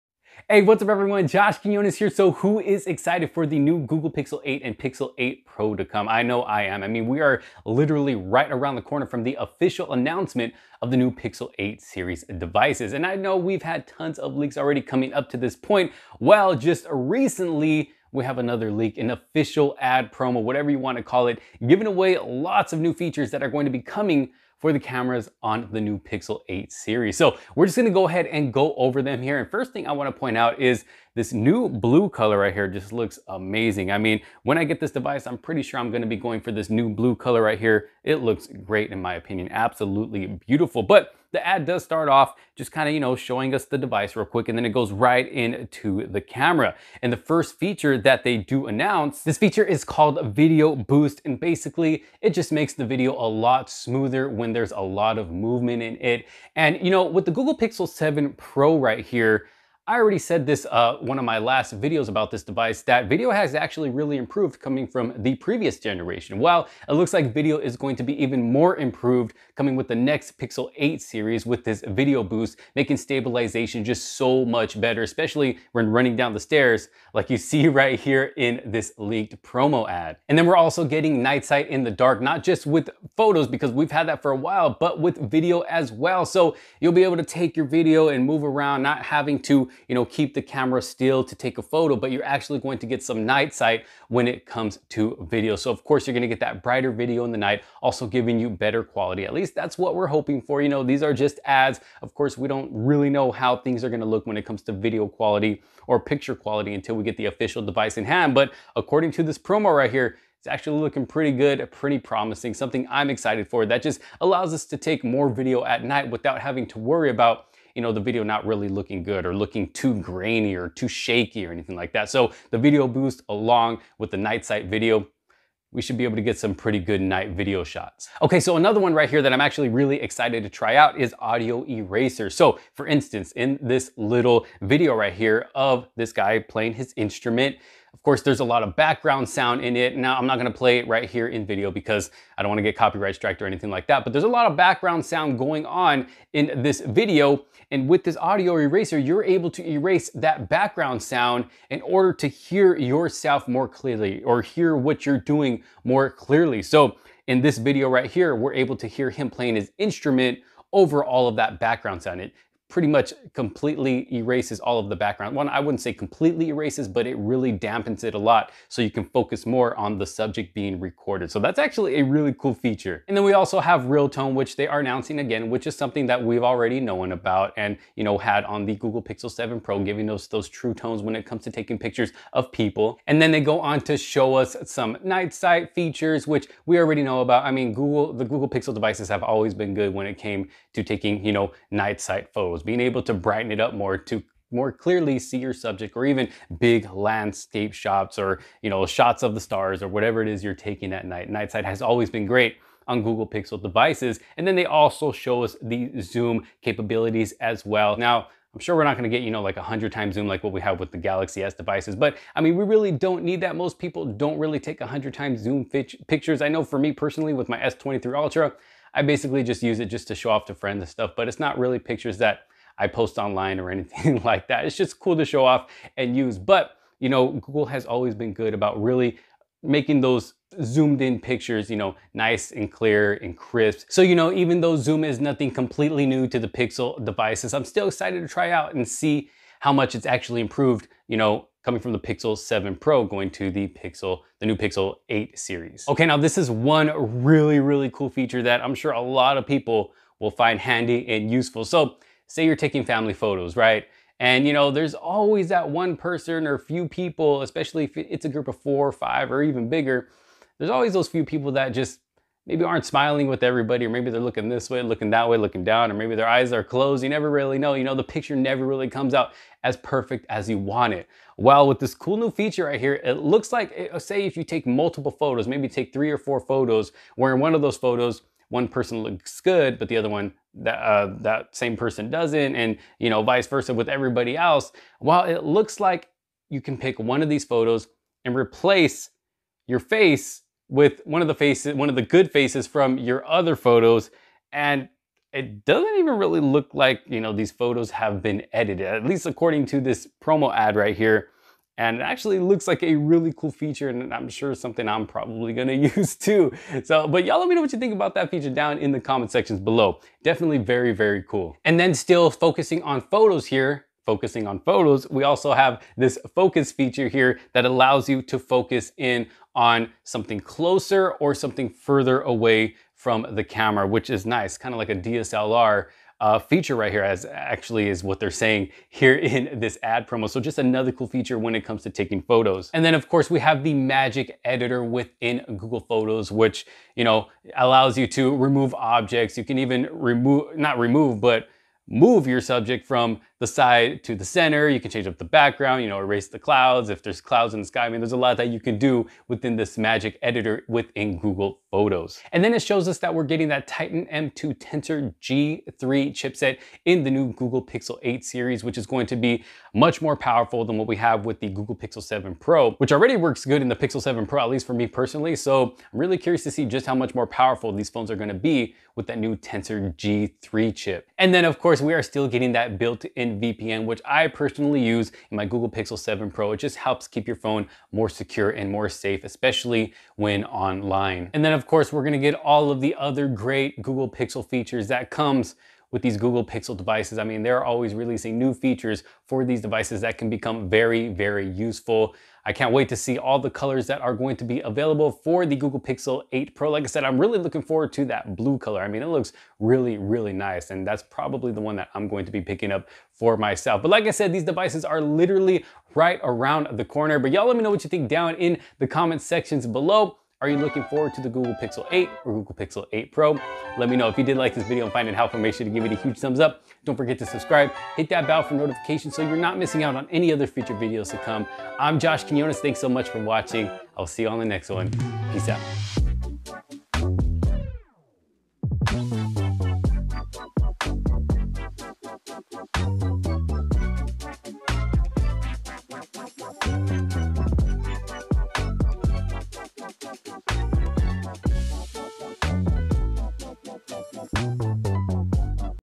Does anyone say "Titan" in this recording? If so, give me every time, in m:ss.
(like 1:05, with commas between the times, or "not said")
5:53.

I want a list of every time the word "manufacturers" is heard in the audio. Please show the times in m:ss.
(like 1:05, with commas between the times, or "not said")
not said.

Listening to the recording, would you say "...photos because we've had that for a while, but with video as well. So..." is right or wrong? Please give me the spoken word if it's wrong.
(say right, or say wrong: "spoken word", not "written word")
right.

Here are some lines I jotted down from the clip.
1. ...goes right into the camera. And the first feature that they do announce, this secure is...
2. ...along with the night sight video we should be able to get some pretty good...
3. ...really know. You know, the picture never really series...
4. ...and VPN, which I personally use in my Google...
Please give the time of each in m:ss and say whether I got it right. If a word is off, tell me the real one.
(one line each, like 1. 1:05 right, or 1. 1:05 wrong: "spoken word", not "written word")
1. 0:44 wrong: "feature", not "secure"
2. 2:03 right
3. 4:27 wrong: "comes", not "series"
4. 6:13 right.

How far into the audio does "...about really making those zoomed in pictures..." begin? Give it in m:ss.
3:48.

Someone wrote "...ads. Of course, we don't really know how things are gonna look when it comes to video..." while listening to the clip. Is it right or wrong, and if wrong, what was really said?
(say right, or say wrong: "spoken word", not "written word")
right.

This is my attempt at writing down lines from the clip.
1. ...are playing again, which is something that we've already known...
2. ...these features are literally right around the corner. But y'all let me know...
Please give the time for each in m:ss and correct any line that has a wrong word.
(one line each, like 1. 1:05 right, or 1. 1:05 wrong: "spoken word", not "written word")
1. 2:54 wrong: "announcing", not "playing"
2. 6:44 wrong: "devices", not "features".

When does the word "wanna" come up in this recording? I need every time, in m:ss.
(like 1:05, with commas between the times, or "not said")
0:29, 2:22.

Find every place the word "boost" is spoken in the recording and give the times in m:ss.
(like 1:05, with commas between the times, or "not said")
0:50, 1:12, 2:02.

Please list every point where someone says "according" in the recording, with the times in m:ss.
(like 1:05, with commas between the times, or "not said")
1:48, 4:59.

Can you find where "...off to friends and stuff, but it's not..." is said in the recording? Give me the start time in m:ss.
3:40.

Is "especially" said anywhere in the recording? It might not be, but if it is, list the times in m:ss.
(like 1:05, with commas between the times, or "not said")
1:15, 4:17, 6:19.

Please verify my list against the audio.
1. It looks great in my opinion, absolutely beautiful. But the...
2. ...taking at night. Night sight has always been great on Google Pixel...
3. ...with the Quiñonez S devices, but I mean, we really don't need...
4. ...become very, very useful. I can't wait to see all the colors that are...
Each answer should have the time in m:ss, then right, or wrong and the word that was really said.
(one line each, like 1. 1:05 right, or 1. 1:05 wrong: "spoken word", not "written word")
1. 0:38 right
2. 3:20 right
3. 3:30 wrong: "Galaxy", not "Quiñonez"
4. 6:30 right.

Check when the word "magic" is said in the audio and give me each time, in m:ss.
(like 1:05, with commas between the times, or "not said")
5:33, 5:49.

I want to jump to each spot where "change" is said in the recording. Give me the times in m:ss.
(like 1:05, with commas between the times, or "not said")
5:44.